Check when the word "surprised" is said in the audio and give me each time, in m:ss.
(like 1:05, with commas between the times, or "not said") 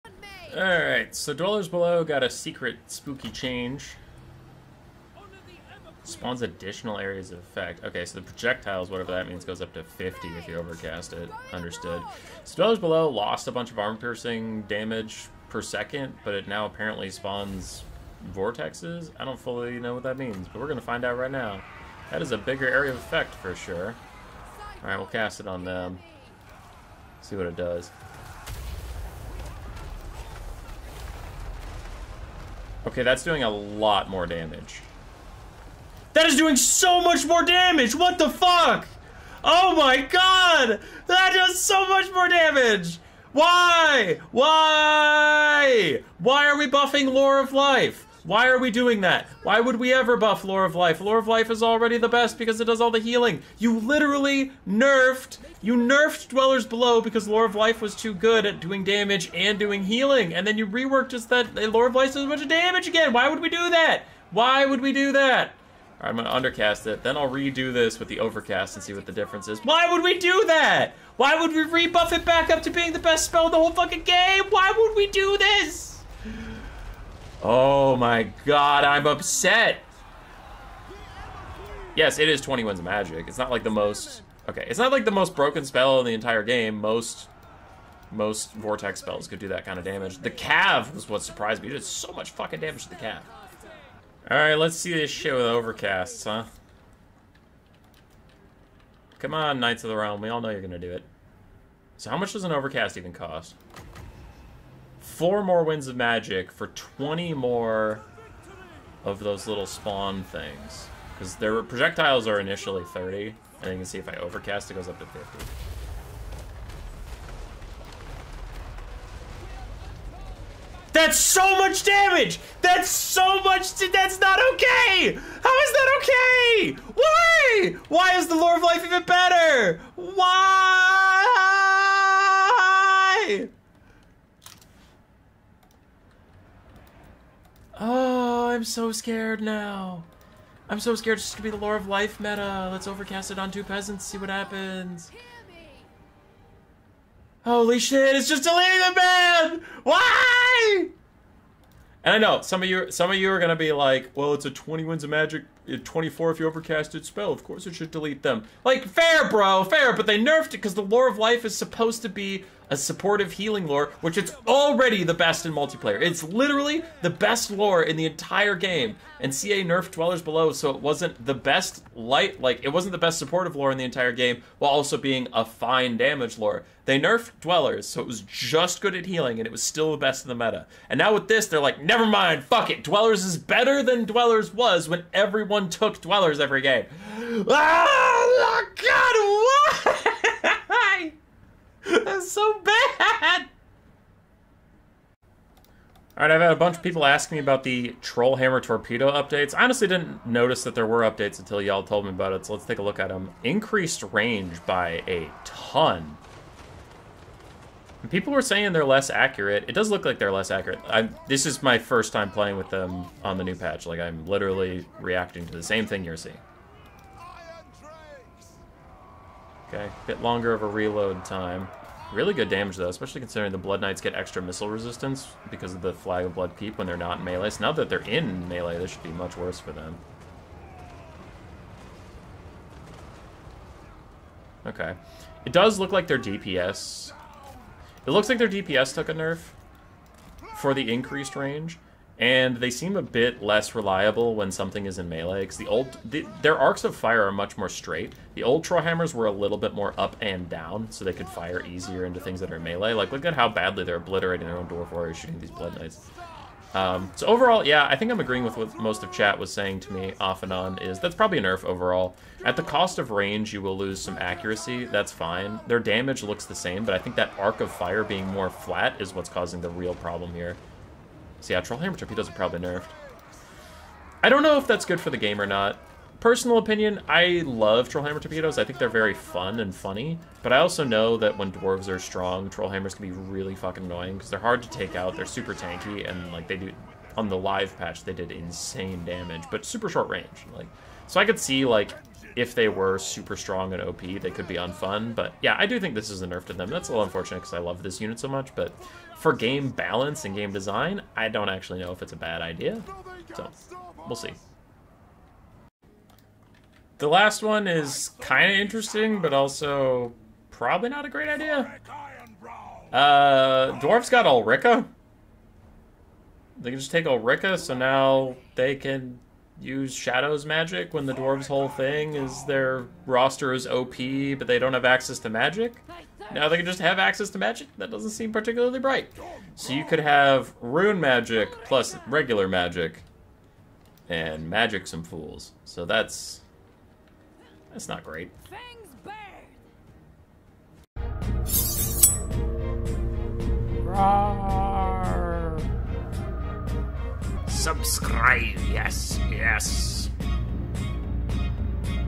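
1:31.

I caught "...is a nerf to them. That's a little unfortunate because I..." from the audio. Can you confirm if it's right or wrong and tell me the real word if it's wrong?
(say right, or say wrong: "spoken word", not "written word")
right.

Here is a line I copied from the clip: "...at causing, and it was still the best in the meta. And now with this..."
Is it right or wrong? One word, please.
wrong.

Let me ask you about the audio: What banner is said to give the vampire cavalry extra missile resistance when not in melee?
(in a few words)
Flag of Blood Keep.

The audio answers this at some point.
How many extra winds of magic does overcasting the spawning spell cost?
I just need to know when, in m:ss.
1:45.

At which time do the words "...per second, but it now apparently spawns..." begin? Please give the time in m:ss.
0:15.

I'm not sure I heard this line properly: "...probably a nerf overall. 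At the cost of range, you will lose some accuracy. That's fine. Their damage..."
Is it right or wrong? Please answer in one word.
right.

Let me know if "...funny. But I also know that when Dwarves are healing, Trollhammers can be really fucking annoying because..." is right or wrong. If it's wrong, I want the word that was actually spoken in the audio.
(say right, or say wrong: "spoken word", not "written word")
wrong: "strong", not "healing".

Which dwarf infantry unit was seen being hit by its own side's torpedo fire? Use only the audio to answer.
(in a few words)
Dwarf Warriors.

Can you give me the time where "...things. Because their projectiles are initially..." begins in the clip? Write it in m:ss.
1:50.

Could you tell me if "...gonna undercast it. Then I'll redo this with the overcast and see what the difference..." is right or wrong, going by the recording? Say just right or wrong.
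right.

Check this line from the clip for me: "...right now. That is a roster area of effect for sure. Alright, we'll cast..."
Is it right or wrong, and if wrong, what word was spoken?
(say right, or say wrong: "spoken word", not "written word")
wrong: "bigger", not "roster".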